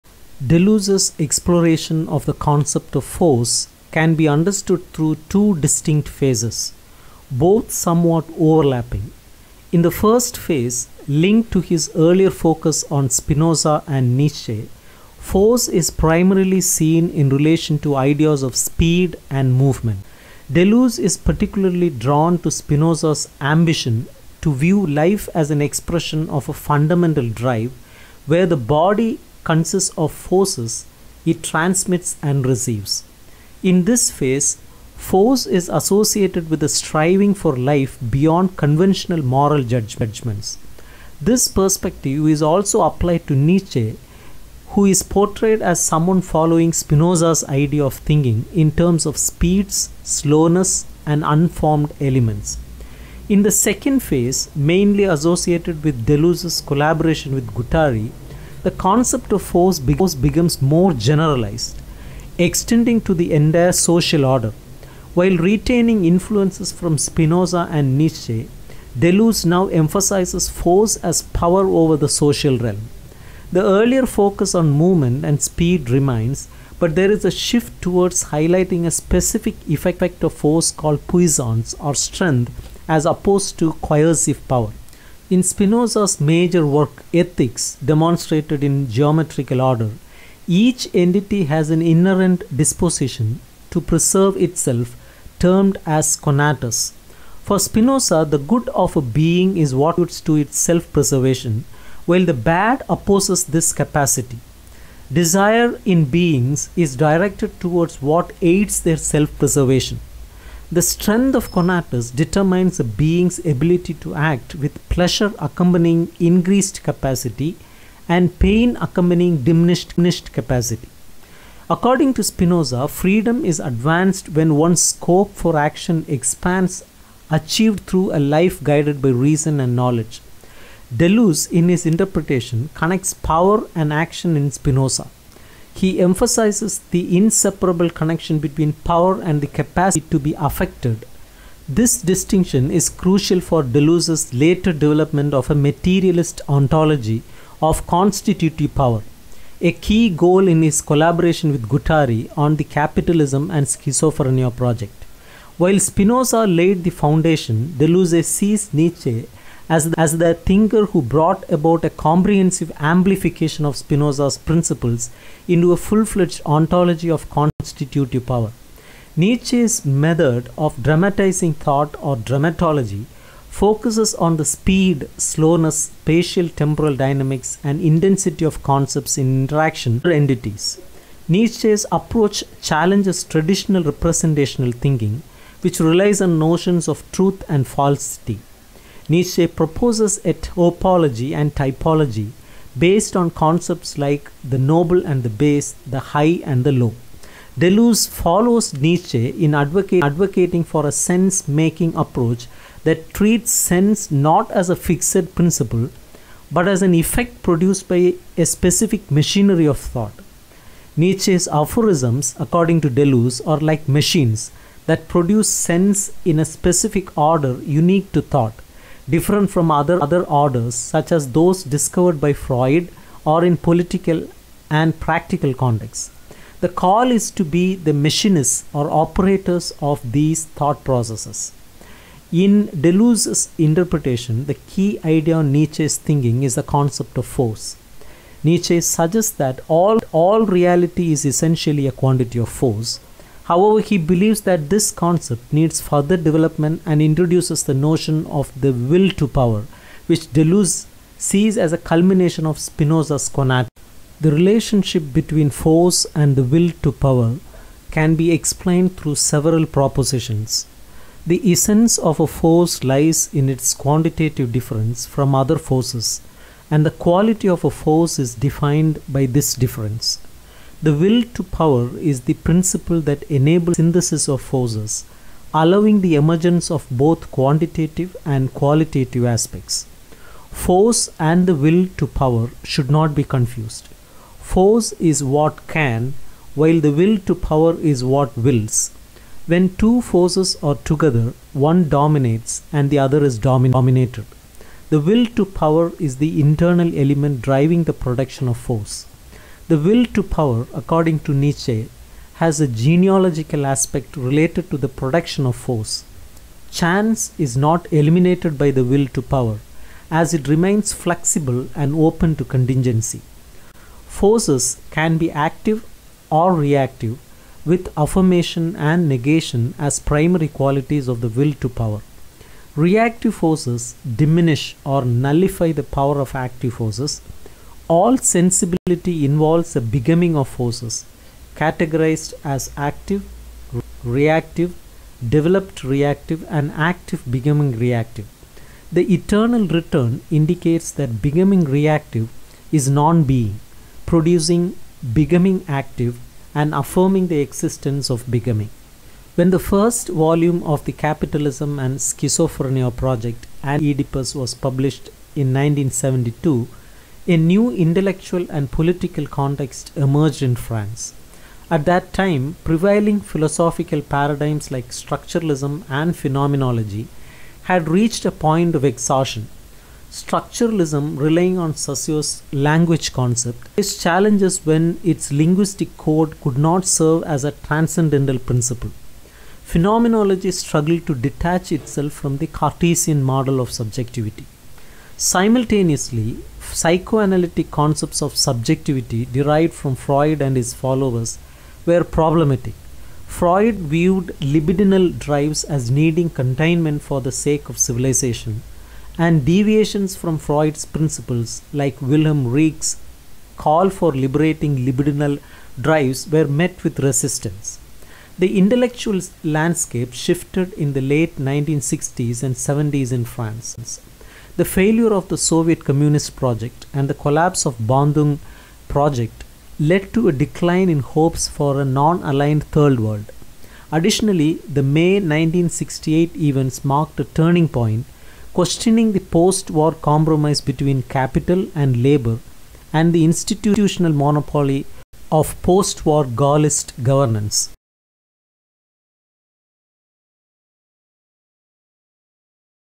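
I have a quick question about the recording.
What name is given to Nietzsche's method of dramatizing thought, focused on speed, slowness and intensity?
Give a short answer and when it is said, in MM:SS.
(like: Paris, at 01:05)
dramatology, at 02:52.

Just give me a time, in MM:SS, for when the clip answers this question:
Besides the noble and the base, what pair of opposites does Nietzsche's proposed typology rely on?
03:15.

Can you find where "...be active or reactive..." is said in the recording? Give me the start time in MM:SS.
05:15.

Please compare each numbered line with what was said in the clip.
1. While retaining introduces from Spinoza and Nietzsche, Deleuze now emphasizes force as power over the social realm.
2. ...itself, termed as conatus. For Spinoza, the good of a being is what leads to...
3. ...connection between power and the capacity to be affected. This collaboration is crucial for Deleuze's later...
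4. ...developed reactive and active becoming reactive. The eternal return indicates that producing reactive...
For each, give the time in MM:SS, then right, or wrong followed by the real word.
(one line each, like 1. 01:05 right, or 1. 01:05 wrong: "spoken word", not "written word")
1. 01:05 wrong: "influences", not "introduces"
2. 01:34 right
3. 02:17 wrong: "distinction", not "collaboration"
4. 05:35 wrong: "becoming", not "producing".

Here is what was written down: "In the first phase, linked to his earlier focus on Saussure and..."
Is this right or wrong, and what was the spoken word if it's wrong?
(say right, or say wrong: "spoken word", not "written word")
wrong: "Spinoza", not "Saussure".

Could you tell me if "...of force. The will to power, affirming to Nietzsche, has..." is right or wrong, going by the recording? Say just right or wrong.
wrong.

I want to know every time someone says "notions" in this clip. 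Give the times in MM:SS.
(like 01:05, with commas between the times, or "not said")
03:06, 04:07.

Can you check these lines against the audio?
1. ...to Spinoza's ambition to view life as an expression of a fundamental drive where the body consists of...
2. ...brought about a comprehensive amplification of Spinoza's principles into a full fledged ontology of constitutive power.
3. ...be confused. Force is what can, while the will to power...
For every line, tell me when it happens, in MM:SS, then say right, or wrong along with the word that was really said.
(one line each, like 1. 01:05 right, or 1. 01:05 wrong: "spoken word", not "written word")
1. 00:22 right
2. 02:41 right
3. 04:43 right.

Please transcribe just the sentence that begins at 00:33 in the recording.
In this phase, force is associated with a striving for life beyond conventional moral judgments.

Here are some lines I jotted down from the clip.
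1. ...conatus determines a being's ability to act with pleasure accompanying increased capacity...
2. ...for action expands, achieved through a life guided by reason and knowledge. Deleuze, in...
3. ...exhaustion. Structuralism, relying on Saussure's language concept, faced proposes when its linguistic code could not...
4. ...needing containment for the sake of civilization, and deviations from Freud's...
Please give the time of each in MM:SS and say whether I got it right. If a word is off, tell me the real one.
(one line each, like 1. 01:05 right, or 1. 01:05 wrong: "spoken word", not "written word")
1. 01:51 right
2. 02:05 right
3. 06:08 wrong: "challenges", not "proposes"
4. 06:35 right.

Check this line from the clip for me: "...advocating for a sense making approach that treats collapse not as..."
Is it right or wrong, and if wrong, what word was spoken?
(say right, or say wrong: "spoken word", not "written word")
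wrong: "sense", not "collapse".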